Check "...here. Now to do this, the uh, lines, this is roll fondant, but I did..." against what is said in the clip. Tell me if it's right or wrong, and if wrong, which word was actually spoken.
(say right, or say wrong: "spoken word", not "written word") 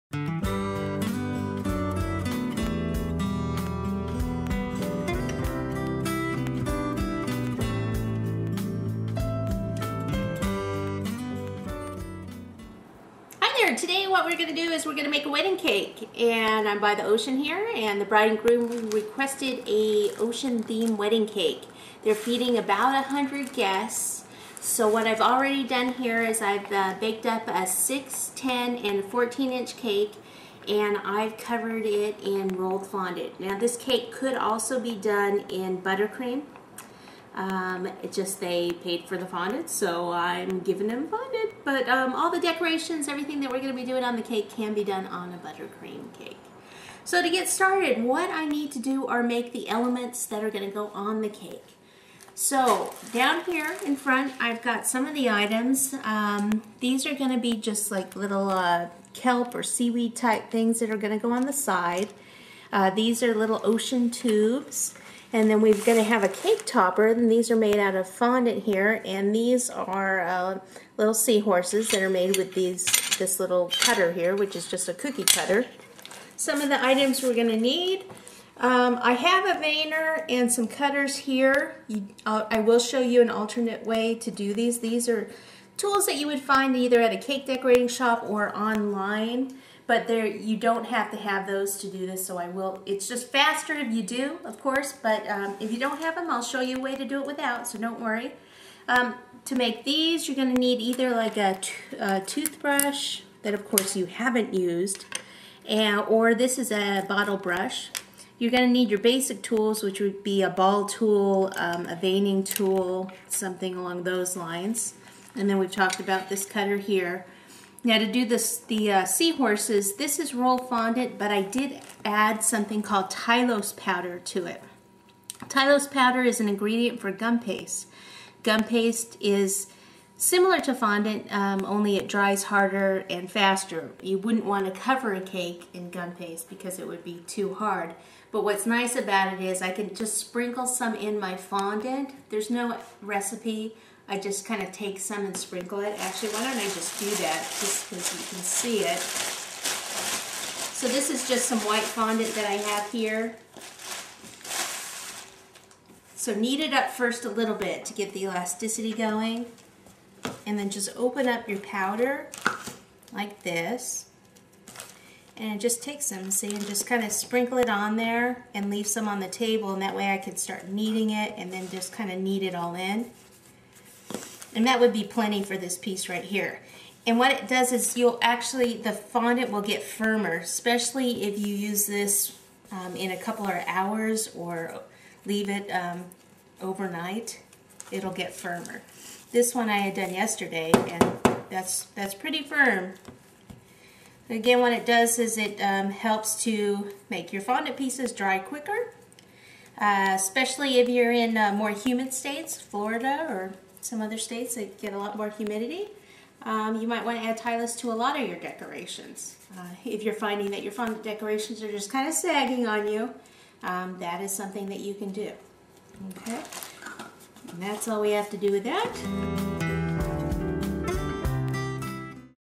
wrong: "seahorses", not "lines".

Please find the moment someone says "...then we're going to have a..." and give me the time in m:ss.
1:05.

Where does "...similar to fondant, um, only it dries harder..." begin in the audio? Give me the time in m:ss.
2:10.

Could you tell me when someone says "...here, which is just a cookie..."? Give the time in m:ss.
1:14.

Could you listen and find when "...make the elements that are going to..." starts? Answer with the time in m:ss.
0:49.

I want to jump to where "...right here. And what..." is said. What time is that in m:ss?
2:56.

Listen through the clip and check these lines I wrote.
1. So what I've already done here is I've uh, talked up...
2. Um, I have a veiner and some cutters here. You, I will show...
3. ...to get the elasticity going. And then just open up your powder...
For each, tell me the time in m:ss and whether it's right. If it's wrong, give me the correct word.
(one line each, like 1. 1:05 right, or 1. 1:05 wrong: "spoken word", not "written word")
1. 0:24 wrong: "baked", not "talked"
2. 1:18 right
3. 2:37 right.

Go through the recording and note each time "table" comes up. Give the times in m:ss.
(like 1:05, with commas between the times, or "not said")
2:49.